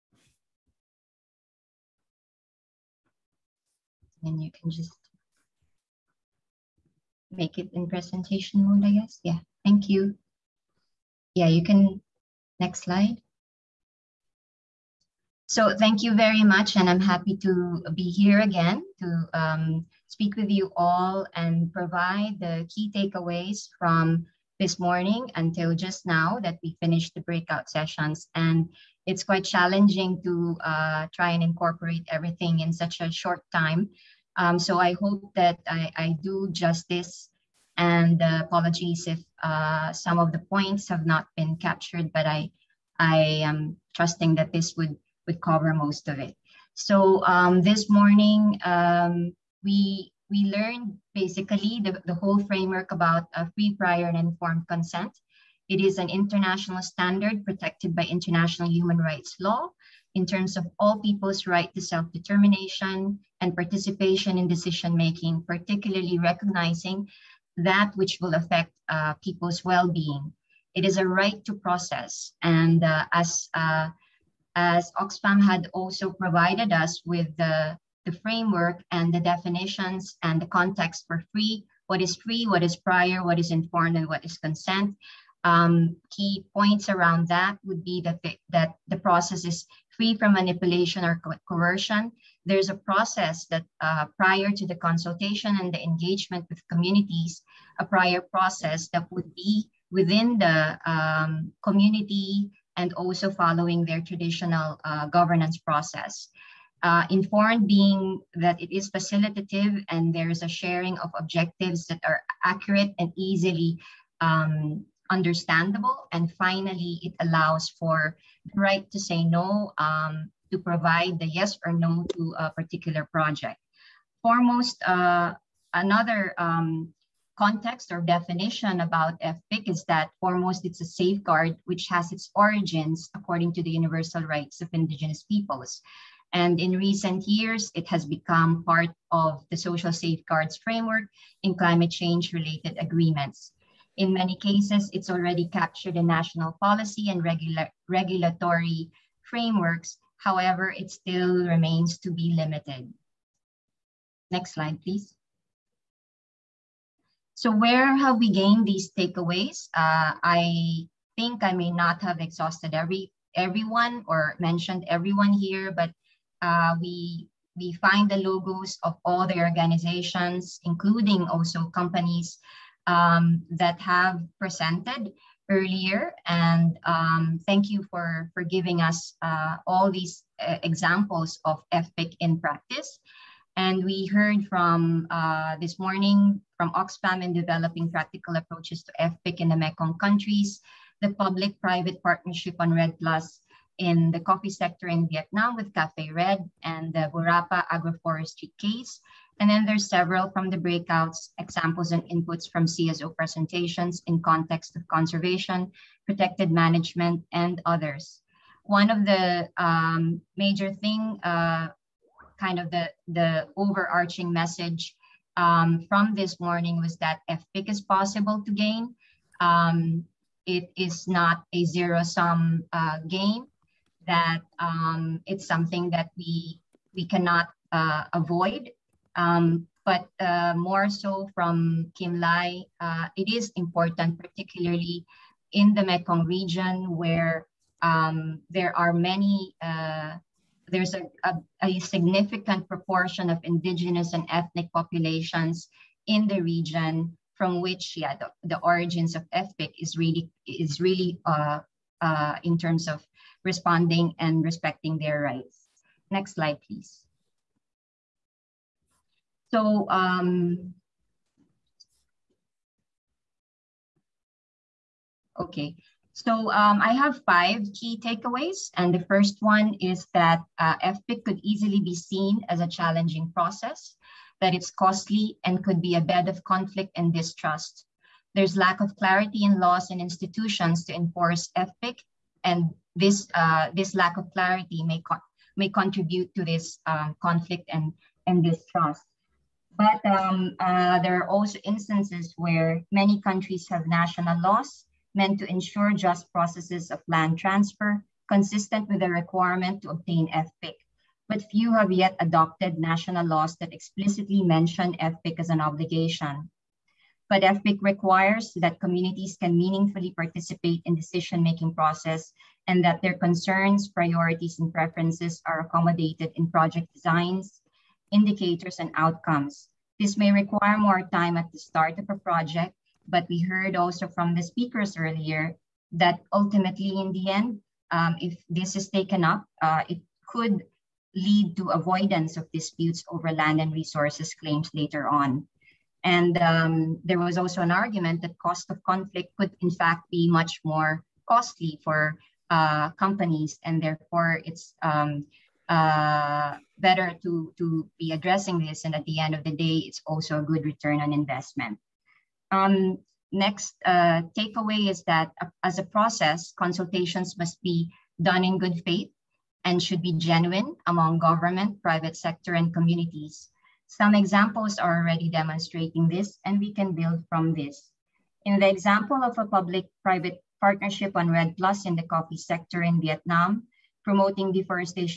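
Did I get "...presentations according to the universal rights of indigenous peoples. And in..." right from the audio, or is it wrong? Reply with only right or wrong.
wrong.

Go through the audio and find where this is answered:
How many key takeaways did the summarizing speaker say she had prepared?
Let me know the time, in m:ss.
4:27.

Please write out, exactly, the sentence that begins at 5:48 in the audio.
And at the end of the day, it's also a good return on investment.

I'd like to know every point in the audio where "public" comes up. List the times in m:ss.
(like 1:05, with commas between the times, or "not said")
3:11, 6:09.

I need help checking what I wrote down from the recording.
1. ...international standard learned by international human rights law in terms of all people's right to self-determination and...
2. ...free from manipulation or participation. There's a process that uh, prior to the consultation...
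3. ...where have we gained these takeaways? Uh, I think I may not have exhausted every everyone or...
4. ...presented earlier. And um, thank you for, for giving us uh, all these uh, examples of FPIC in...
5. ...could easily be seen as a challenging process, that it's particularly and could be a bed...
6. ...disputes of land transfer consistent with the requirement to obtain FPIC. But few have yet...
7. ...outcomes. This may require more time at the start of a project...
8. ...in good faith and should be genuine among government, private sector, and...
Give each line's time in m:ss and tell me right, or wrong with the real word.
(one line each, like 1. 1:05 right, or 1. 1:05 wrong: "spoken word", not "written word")
1. 0:56 wrong: "protected", not "learned"
2. 1:29 wrong: "coercion", not "participation"
3. 2:37 right
4. 2:54 right
5. 4:31 wrong: "costly", not "particularly"
6. 4:56 wrong: "processes", not "disputes"
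7. 5:18 right
8. 5:58 right.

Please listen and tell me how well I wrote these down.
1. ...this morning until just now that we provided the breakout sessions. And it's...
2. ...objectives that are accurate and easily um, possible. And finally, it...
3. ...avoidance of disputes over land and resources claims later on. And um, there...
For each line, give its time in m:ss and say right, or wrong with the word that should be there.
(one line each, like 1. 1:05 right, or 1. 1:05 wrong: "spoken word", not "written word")
1. 0:24 wrong: "finished", not "provided"
2. 1:51 wrong: "understandable", not "possible"
3. 5:31 right.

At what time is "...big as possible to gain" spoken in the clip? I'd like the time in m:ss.
3:37.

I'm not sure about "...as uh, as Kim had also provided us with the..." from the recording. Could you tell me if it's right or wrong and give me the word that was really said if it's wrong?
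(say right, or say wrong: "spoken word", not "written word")
wrong: "Oxfam", not "Kim".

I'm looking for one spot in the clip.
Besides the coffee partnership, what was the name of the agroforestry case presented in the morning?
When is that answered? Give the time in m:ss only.
3:17.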